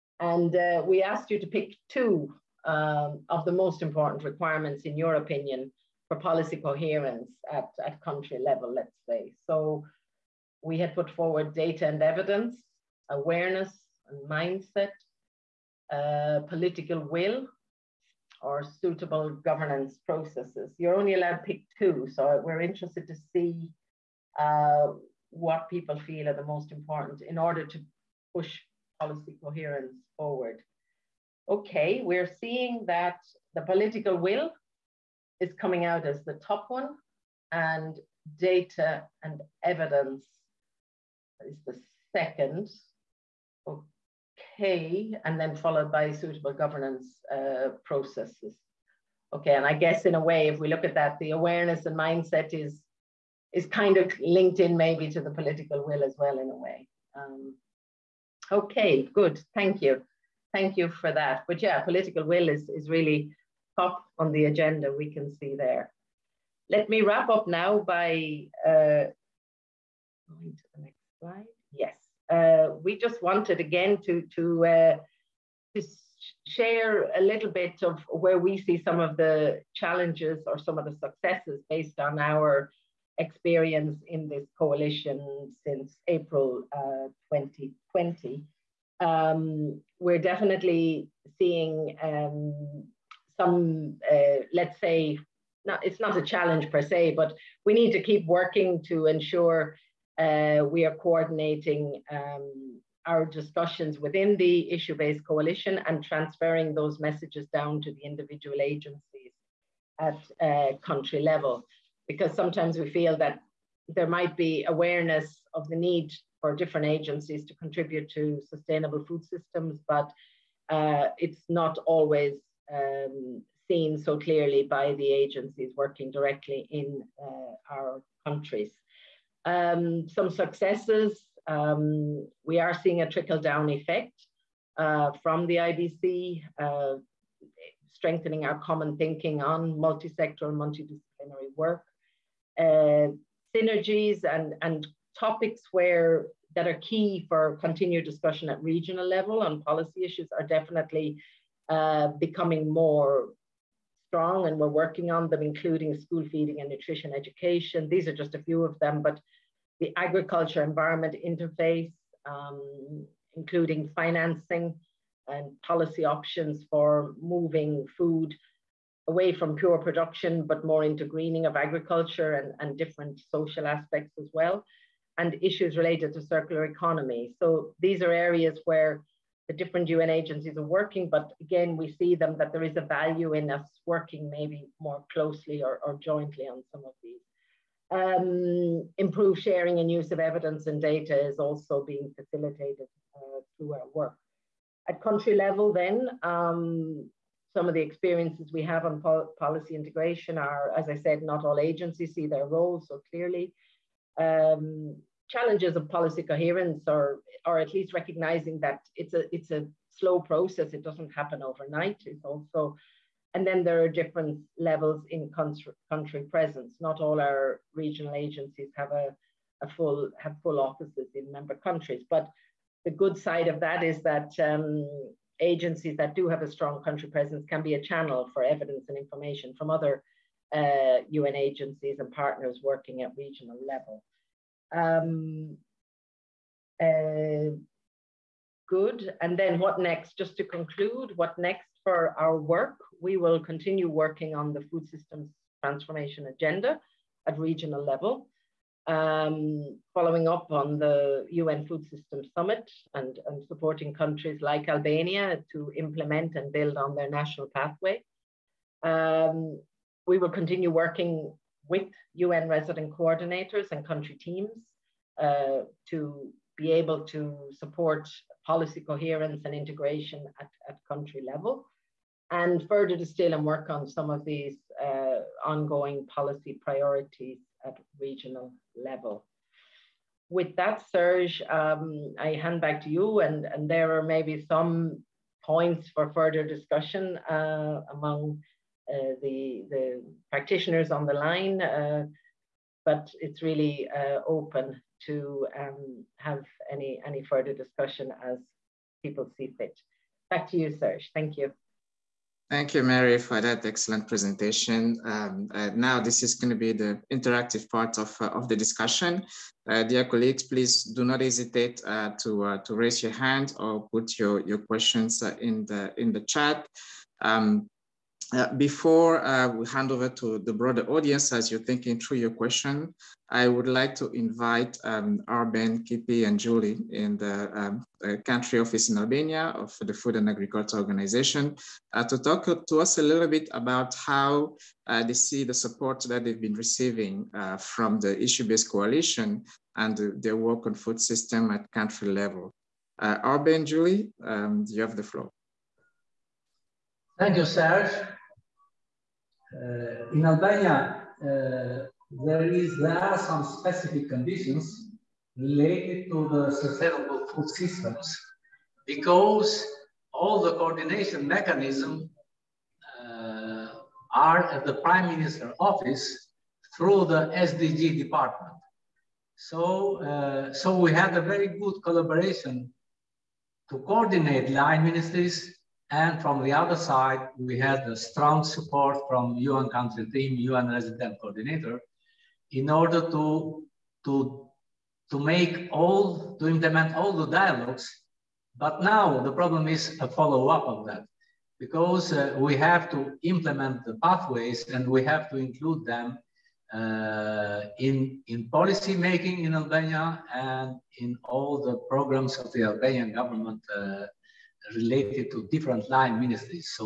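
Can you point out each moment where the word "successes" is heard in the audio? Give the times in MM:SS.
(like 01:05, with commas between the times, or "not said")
01:20, 02:10.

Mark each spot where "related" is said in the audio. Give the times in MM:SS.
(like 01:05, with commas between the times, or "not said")
02:55, 05:55, 06:44.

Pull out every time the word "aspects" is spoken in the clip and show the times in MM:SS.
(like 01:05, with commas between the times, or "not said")
02:53.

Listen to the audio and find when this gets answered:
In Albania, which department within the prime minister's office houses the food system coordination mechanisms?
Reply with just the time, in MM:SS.
06:07.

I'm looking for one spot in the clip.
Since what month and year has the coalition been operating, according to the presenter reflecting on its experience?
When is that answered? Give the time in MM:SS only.
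01:26.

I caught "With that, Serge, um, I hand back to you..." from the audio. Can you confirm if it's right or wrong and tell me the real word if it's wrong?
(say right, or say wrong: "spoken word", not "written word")
right.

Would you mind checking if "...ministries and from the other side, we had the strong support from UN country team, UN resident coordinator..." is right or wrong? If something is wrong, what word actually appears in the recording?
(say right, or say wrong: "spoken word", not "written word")
right.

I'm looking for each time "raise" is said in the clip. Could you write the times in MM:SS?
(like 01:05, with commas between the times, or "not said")
05:12.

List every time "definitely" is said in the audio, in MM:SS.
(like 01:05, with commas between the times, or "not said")
01:30, 02:30.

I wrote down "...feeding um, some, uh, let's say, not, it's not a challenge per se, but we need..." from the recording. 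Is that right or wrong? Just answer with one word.
wrong.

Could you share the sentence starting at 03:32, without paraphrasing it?
It's also and then there are different levels in country, country presence.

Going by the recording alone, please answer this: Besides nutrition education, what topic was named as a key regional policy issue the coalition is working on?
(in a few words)
School feeding.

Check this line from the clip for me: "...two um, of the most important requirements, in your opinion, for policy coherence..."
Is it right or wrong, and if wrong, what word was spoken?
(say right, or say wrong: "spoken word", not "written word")
right.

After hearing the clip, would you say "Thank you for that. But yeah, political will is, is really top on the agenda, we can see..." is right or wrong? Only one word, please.
right.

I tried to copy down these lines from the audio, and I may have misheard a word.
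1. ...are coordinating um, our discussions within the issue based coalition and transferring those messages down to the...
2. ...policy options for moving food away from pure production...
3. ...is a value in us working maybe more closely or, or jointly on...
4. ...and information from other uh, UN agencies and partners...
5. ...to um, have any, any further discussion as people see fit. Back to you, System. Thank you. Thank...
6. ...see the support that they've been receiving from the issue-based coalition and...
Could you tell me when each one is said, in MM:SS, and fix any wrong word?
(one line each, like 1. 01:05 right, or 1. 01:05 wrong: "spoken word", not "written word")
1. 01:40 right
2. 02:45 right
3. 03:02 right
4. 03:48 right
5. 04:55 wrong: "Serge", not "System"
6. 05:35 right.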